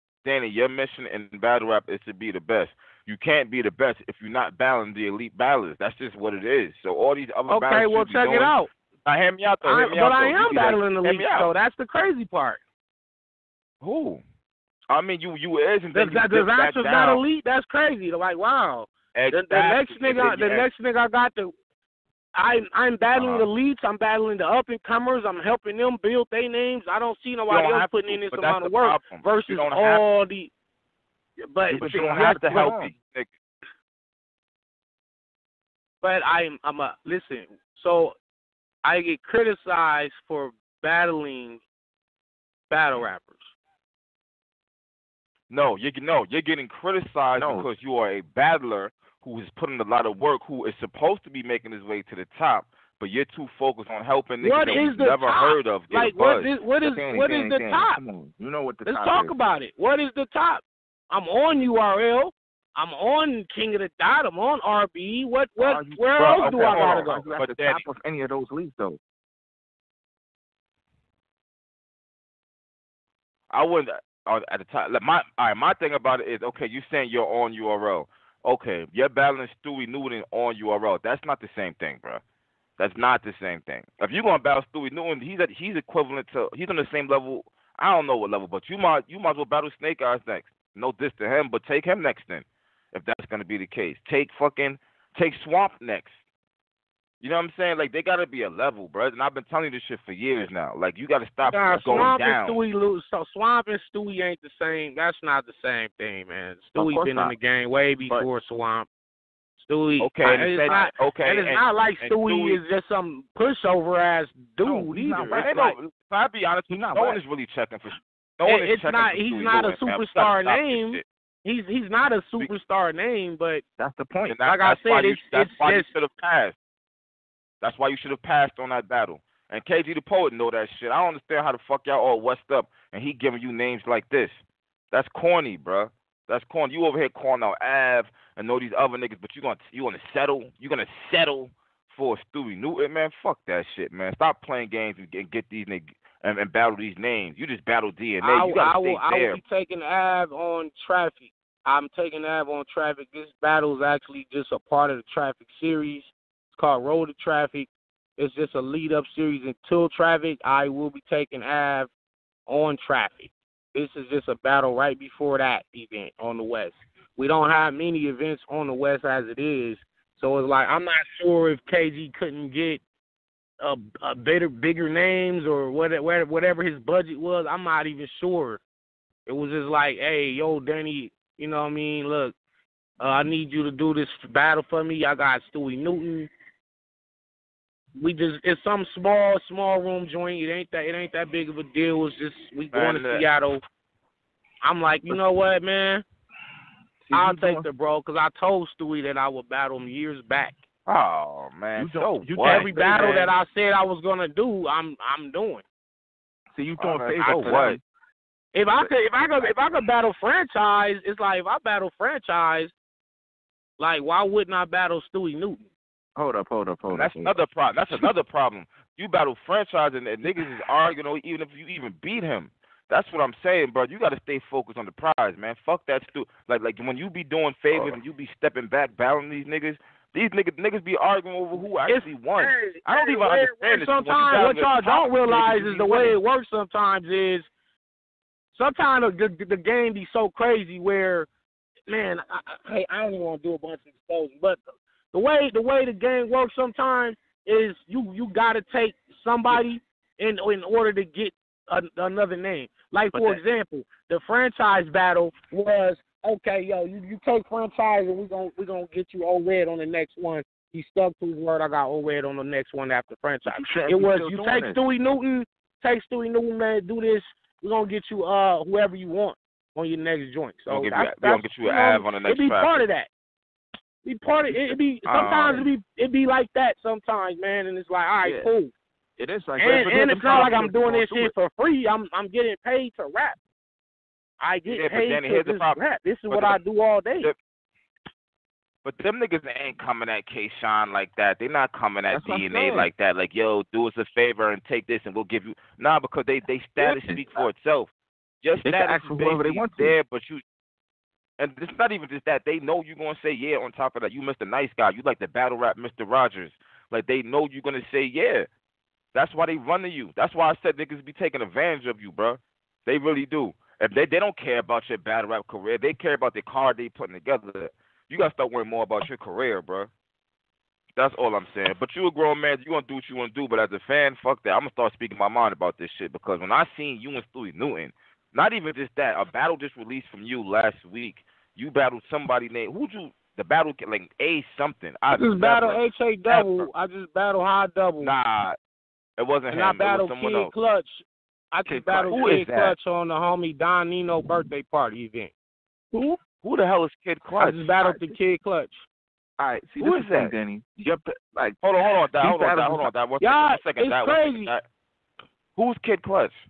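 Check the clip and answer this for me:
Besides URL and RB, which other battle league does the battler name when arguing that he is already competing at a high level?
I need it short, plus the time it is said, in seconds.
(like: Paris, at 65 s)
King of the Dot, at 63 s.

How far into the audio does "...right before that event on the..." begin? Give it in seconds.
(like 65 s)
164 s.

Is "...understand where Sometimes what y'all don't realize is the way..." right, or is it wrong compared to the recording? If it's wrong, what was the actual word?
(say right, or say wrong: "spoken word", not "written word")
right.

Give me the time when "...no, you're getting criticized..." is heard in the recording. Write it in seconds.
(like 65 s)
46 s.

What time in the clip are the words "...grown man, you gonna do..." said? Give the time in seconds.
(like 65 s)
322 s.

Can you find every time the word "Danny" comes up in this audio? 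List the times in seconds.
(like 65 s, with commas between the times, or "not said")
180 s, 285 s, 350 s.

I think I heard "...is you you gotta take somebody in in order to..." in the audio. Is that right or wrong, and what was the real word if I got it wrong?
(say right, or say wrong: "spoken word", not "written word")
right.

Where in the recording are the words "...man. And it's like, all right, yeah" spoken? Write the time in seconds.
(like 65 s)
277 s.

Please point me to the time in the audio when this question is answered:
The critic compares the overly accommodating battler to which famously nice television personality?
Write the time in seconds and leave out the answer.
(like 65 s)
305 s.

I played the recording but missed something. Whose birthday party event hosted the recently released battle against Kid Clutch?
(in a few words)
Don Nino.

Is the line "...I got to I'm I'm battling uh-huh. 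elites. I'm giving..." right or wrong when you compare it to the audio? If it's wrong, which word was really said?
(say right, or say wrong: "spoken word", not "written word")
wrong: "battling", not "giving".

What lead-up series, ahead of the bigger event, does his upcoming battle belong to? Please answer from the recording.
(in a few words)
Road to Traffic.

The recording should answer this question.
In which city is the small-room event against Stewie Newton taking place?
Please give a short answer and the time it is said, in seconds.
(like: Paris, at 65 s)
Seattle, at 193 s.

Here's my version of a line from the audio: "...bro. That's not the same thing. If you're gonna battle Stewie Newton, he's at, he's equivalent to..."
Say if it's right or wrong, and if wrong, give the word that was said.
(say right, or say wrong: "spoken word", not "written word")
right.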